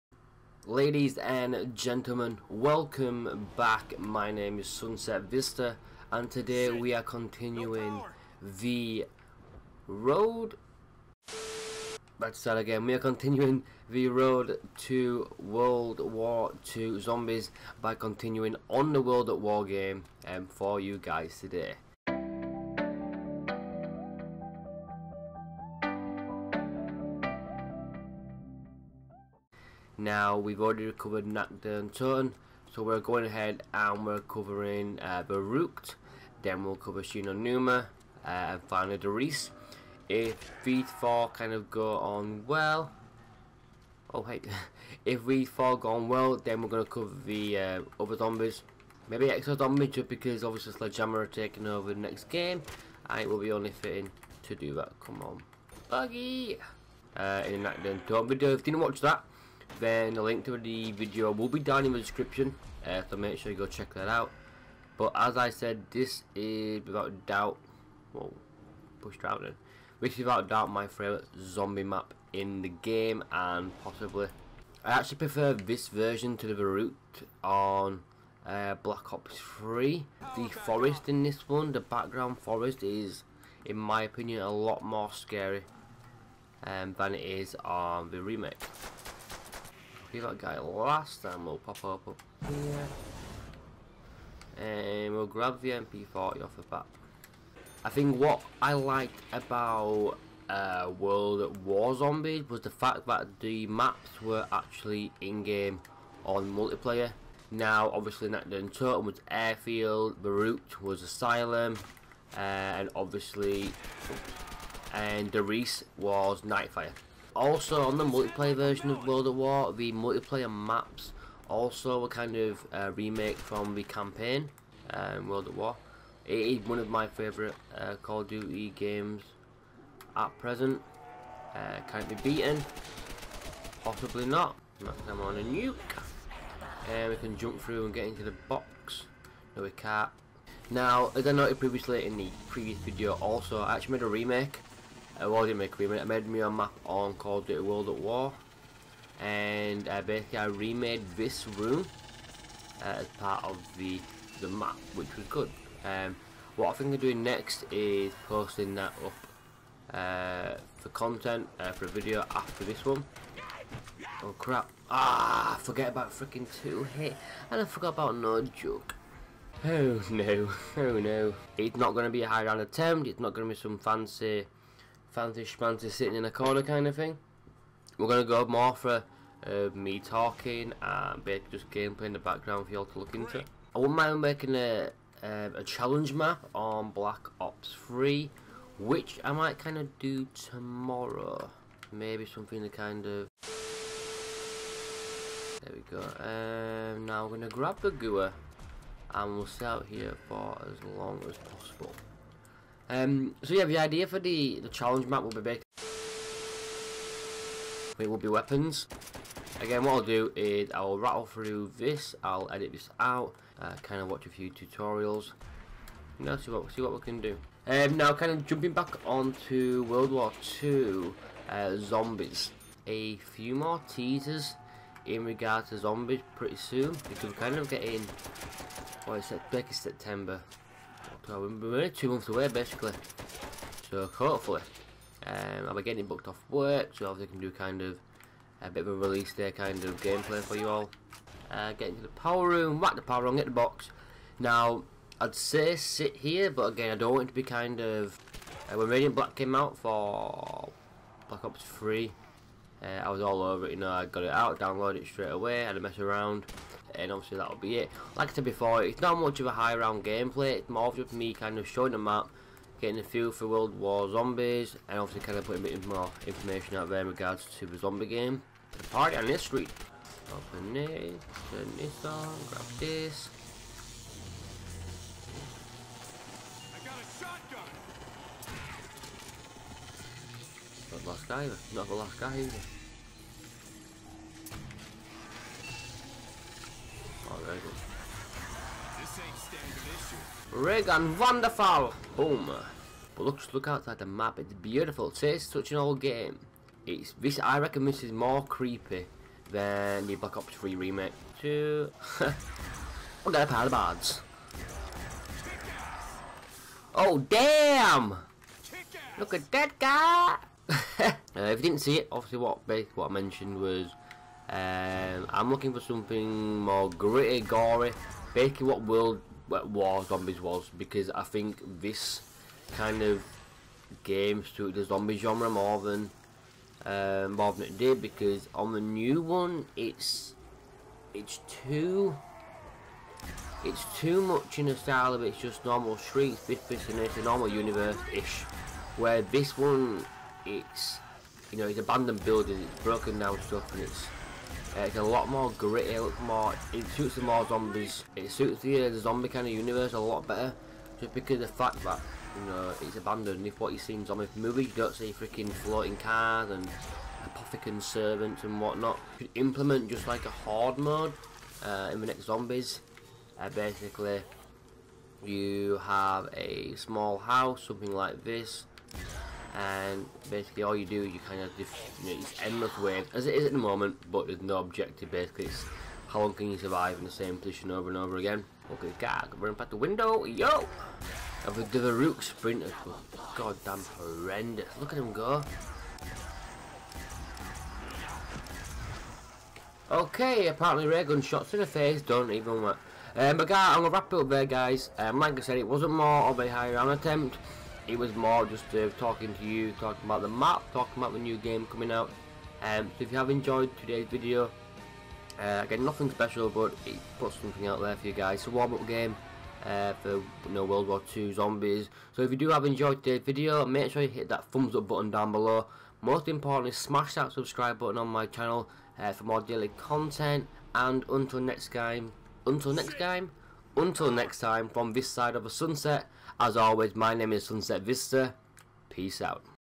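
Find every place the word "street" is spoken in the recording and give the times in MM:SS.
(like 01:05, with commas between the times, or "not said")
04:29, 05:35.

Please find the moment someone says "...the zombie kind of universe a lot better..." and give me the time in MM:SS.
05:48.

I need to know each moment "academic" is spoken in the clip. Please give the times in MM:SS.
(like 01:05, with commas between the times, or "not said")
not said.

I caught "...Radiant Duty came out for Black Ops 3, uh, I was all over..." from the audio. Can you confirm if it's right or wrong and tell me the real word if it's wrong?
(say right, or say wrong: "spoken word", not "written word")
wrong: "Black", not "Duty".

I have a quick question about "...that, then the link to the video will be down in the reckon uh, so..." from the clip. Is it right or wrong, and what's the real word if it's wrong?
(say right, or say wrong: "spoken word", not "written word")
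wrong: "description", not "reckon".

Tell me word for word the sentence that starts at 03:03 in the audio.
I wouldn't mind making a, a, um, a challenge map on Black Ops 3, which I might kind of do tomorrow.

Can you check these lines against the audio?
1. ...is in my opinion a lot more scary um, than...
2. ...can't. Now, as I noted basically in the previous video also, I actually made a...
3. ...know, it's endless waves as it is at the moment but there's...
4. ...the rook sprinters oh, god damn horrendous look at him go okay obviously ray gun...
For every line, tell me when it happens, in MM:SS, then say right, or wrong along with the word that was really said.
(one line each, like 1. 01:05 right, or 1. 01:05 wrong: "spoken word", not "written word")
1. 01:22 right
2. 02:19 wrong: "previously", not "basically"
3. 06:12 right
4. 06:21 wrong: "apparently", not "obviously".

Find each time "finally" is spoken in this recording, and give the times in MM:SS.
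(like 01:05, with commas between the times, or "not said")
00:38.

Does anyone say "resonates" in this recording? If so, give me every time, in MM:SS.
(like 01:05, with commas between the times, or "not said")
not said.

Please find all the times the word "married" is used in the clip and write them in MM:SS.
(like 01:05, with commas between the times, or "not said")
not said.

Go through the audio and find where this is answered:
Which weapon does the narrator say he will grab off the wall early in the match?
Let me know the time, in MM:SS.
01:35.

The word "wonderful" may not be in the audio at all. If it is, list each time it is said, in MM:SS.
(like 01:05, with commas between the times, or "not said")
04:51.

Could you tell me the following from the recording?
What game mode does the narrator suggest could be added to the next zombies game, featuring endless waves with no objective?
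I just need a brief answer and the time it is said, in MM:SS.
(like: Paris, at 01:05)
Horde mode, at 06:00.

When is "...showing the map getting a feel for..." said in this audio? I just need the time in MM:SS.
04:21.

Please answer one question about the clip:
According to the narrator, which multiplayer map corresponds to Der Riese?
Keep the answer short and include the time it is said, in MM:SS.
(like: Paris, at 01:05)
Nightfire, at 01:56.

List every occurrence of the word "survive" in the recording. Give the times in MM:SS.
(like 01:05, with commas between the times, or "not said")
06:16.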